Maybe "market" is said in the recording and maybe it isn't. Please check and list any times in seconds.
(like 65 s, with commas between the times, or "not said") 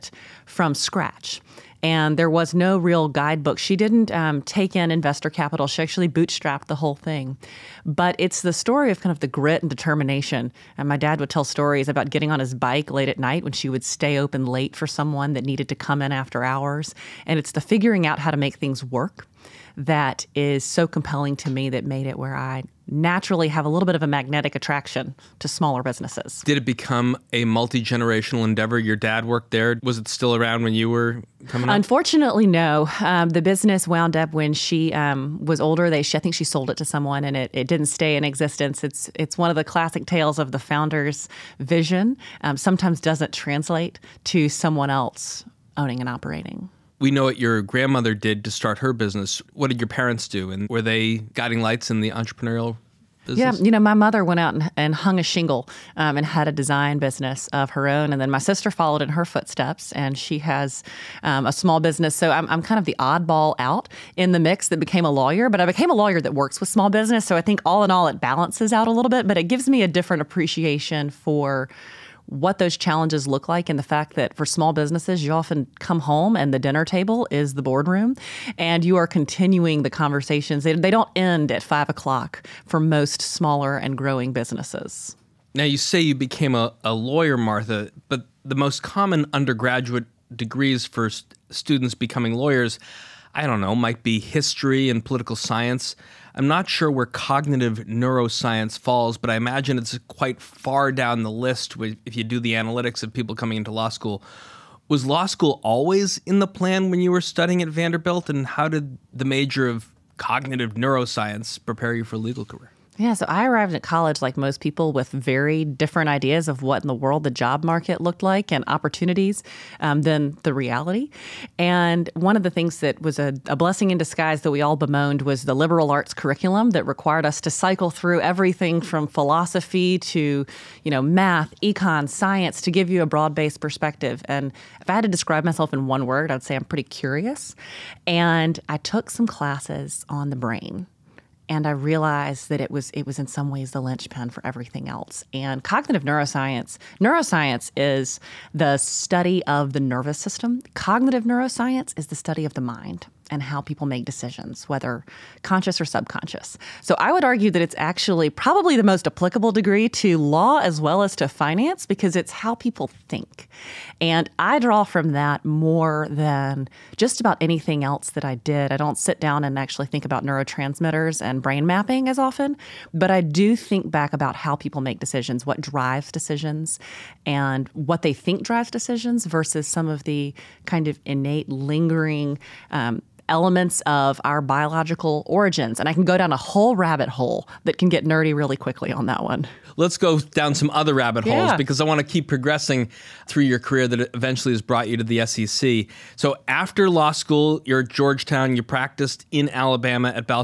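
117 s.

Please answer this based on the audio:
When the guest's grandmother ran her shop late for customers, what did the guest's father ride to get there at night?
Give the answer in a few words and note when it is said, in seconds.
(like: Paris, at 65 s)
His bike, at 12 s.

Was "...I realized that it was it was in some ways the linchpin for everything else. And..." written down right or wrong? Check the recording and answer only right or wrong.
right.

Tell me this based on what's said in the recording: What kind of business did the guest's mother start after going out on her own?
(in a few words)
A design business.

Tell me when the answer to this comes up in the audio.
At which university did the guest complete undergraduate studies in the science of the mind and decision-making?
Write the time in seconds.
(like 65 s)
107 s.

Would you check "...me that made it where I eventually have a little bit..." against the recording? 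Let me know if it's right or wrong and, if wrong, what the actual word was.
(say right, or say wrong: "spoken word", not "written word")
wrong: "naturally", not "eventually".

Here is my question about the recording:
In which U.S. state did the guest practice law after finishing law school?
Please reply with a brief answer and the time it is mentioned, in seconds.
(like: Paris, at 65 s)
Alabama, at 199 s.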